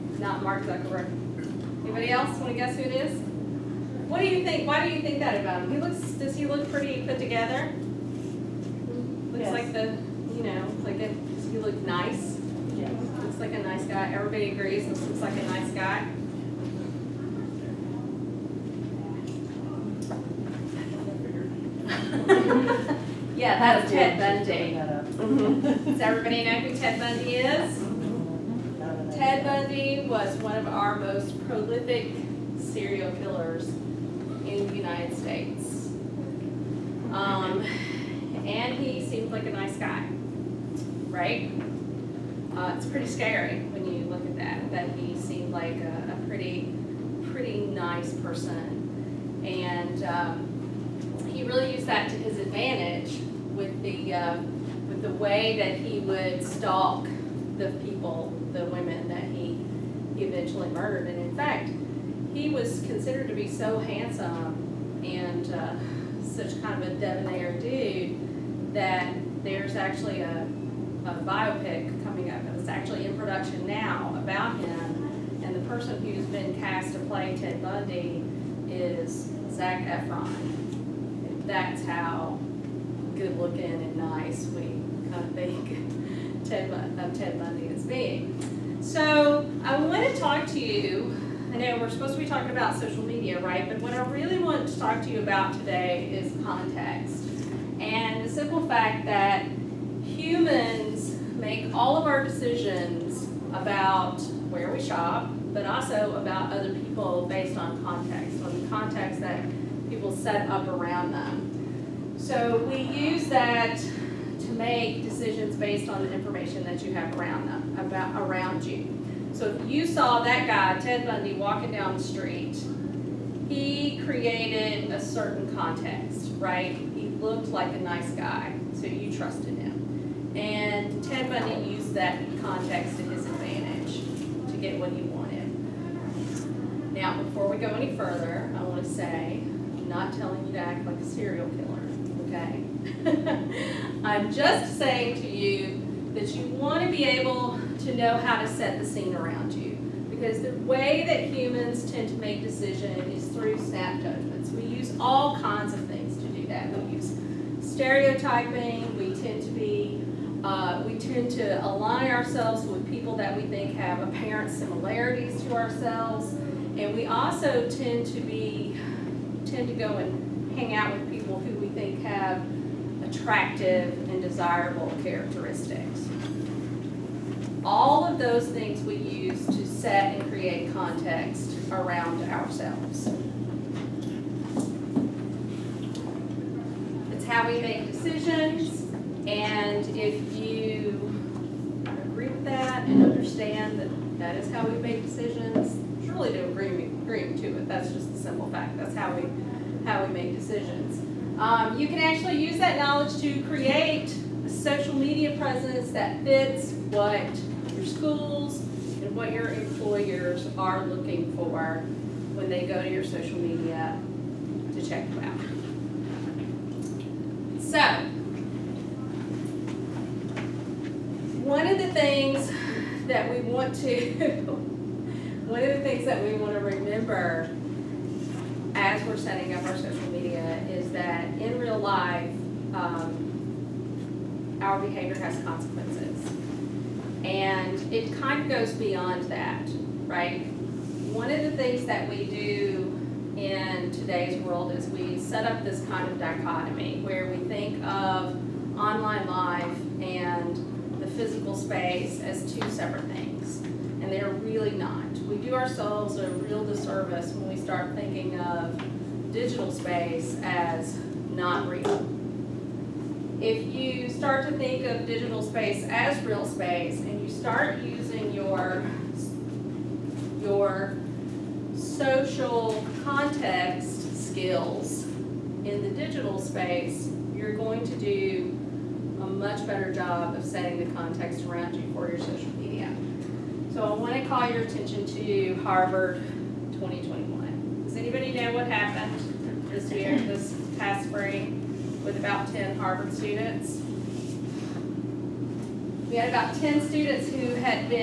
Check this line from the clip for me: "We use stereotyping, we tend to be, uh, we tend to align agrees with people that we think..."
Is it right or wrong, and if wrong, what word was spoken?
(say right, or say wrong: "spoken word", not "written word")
wrong: "ourselves", not "agrees".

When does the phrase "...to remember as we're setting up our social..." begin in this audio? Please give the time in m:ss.
3:46.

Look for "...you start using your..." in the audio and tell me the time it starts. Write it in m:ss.
4:27.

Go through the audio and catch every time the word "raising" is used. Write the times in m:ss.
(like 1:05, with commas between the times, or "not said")
not said.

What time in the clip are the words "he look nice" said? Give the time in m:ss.
0:11.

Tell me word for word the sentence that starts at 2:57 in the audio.
All of those things we use to set and create context around ourselves.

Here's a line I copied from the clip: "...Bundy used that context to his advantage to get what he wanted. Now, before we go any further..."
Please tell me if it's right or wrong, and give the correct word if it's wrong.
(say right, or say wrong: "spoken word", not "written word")
right.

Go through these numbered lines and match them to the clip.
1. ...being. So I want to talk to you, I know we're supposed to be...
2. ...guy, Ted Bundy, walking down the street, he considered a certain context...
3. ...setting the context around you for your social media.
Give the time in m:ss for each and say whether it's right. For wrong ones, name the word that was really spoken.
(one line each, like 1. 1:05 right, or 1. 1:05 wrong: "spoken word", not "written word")
1. 1:27 right
2. 2:00 wrong: "created", not "considered"
3. 4:40 right.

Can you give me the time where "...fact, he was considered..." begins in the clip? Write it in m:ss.
1:01.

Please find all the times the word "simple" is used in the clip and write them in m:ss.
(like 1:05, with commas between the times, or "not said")
1:38, 3:18.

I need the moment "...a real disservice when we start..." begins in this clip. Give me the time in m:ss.
4:16.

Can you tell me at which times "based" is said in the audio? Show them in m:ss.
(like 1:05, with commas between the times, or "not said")
1:47, 1:55.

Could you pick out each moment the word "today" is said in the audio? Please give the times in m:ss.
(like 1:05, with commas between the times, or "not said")
1:35, 4:03.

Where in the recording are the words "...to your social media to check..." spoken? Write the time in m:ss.
3:32.